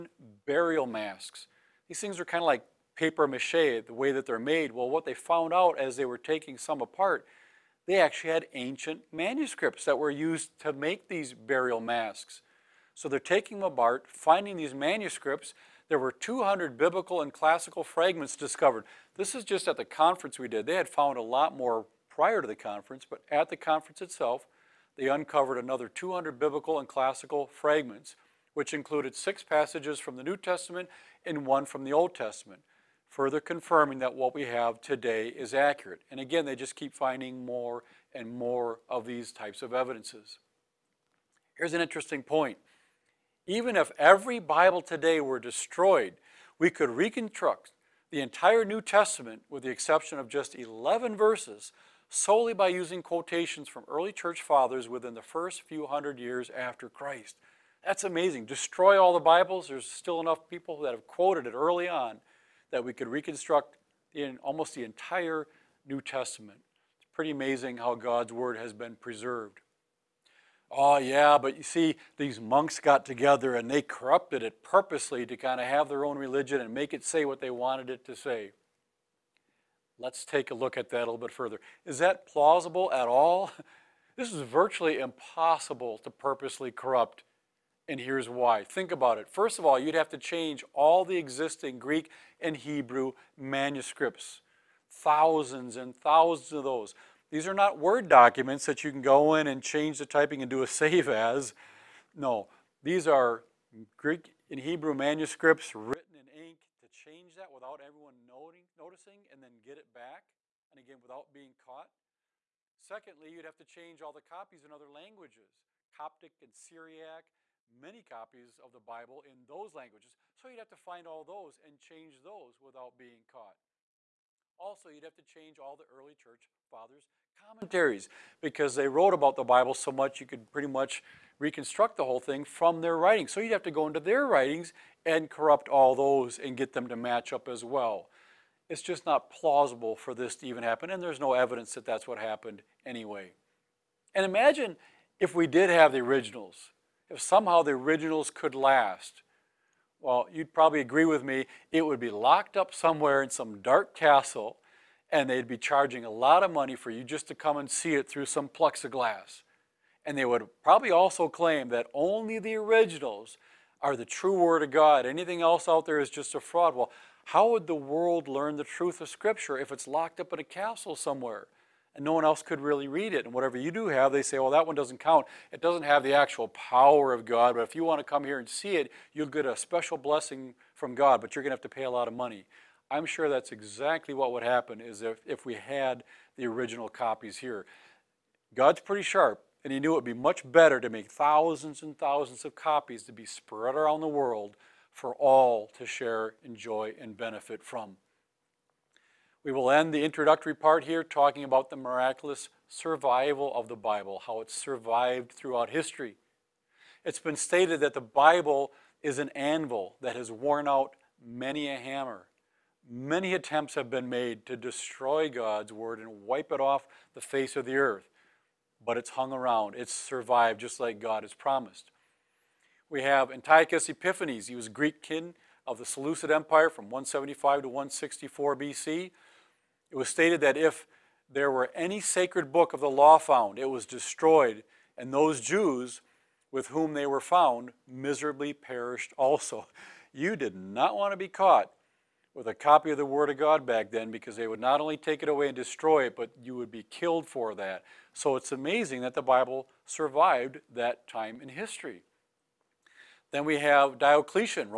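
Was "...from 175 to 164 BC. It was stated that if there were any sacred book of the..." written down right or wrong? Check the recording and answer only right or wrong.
right.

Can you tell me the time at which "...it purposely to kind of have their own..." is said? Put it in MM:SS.
01:14.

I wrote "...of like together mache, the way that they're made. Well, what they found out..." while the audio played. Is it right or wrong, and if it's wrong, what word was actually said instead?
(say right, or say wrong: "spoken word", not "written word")
wrong: "paper", not "together".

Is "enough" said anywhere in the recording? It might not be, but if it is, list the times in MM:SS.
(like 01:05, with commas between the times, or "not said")
01:00.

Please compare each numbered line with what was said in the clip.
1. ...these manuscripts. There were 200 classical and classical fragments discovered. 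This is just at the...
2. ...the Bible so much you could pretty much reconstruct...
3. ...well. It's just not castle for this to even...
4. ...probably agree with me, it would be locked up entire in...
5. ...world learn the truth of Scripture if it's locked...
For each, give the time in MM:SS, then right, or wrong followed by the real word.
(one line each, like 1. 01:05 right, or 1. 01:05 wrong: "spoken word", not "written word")
1. 00:14 wrong: "biblical", not "classical"
2. 02:09 right
3. 02:17 wrong: "plausible", not "castle"
4. 02:30 wrong: "somewhere", not "entire"
5. 02:47 right.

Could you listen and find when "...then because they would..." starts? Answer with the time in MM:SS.
04:03.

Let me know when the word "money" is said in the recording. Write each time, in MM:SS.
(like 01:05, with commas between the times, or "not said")
02:36, 03:02.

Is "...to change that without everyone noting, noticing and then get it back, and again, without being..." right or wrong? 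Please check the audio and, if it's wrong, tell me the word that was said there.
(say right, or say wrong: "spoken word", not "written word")
right.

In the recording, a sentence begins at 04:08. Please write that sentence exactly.
So it's amazing that the Bible survived that time in history.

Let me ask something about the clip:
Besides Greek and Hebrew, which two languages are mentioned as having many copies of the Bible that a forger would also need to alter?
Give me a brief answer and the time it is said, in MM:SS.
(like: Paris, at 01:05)
Coptic and Syriac, at 01:55.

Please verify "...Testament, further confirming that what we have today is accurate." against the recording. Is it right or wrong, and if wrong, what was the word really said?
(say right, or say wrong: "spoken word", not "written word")
right.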